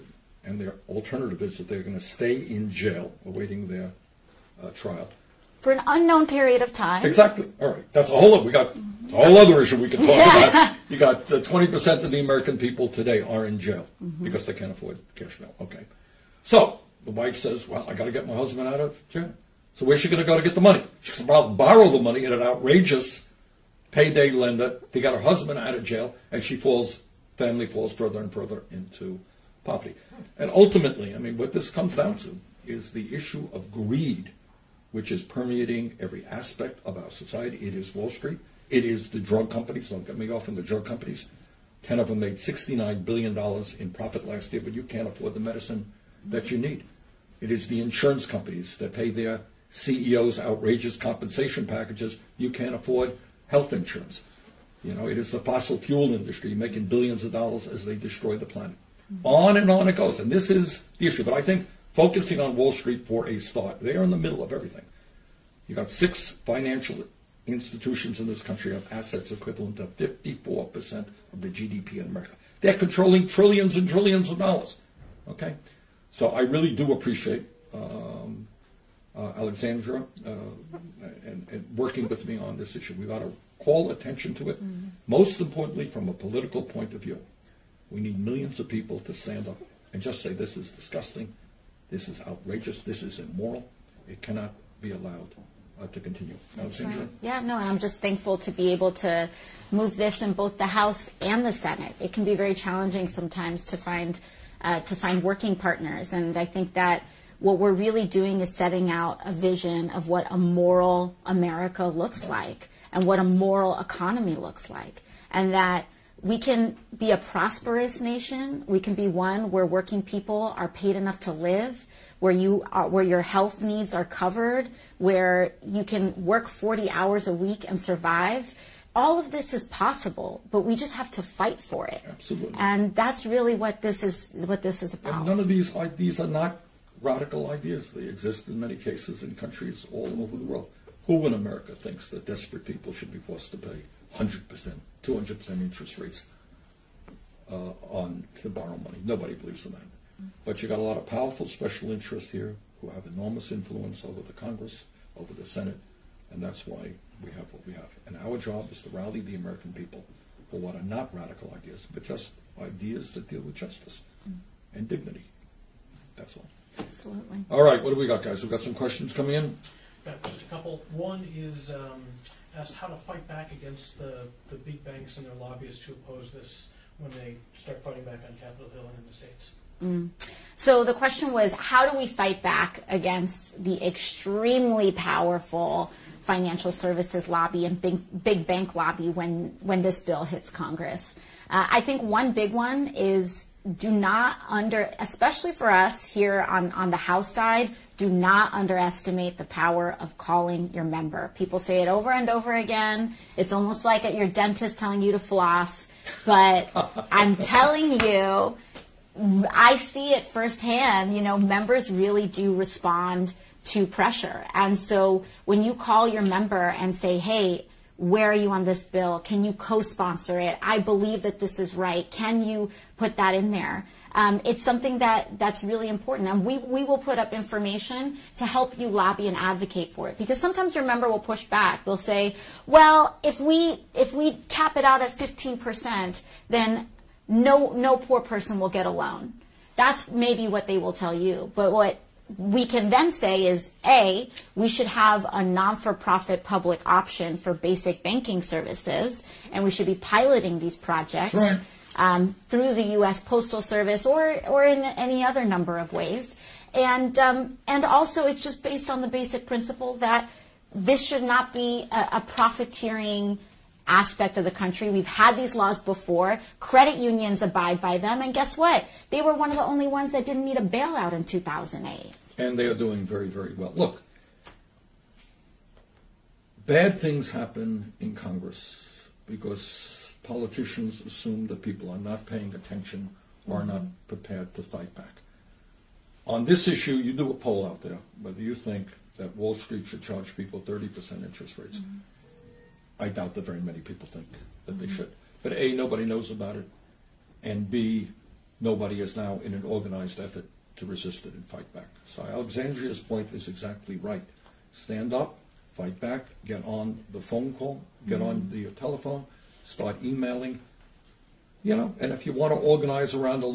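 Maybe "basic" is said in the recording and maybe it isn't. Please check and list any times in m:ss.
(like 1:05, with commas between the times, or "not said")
4:07, 4:19.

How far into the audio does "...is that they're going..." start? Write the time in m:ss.
0:01.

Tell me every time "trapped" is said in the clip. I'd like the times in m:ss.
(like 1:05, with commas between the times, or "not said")
not said.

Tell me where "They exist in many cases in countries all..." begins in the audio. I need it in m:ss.
2:17.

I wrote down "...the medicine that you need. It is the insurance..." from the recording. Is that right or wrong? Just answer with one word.
right.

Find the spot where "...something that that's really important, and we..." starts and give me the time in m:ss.
3:44.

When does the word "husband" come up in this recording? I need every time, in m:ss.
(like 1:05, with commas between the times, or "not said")
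0:18, 0:25.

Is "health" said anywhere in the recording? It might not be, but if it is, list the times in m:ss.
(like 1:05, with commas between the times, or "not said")
0:53, 2:03.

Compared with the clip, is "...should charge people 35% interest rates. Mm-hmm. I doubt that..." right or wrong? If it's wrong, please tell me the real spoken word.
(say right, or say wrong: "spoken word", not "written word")
wrong: "30", not "35".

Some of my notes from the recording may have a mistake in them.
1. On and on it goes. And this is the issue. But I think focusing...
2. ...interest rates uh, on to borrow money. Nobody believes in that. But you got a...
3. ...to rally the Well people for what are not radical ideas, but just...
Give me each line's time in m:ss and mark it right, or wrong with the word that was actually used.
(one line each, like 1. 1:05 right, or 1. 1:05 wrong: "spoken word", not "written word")
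1. 0:59 right
2. 2:25 right
3. 2:38 wrong: "American", not "Well".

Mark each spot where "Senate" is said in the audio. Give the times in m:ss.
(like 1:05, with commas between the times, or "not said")
1:41, 2:35.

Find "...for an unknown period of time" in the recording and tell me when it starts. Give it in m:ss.
0:05.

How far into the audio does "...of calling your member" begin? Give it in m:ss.
3:19.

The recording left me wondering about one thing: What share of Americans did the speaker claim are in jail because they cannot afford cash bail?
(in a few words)
20%.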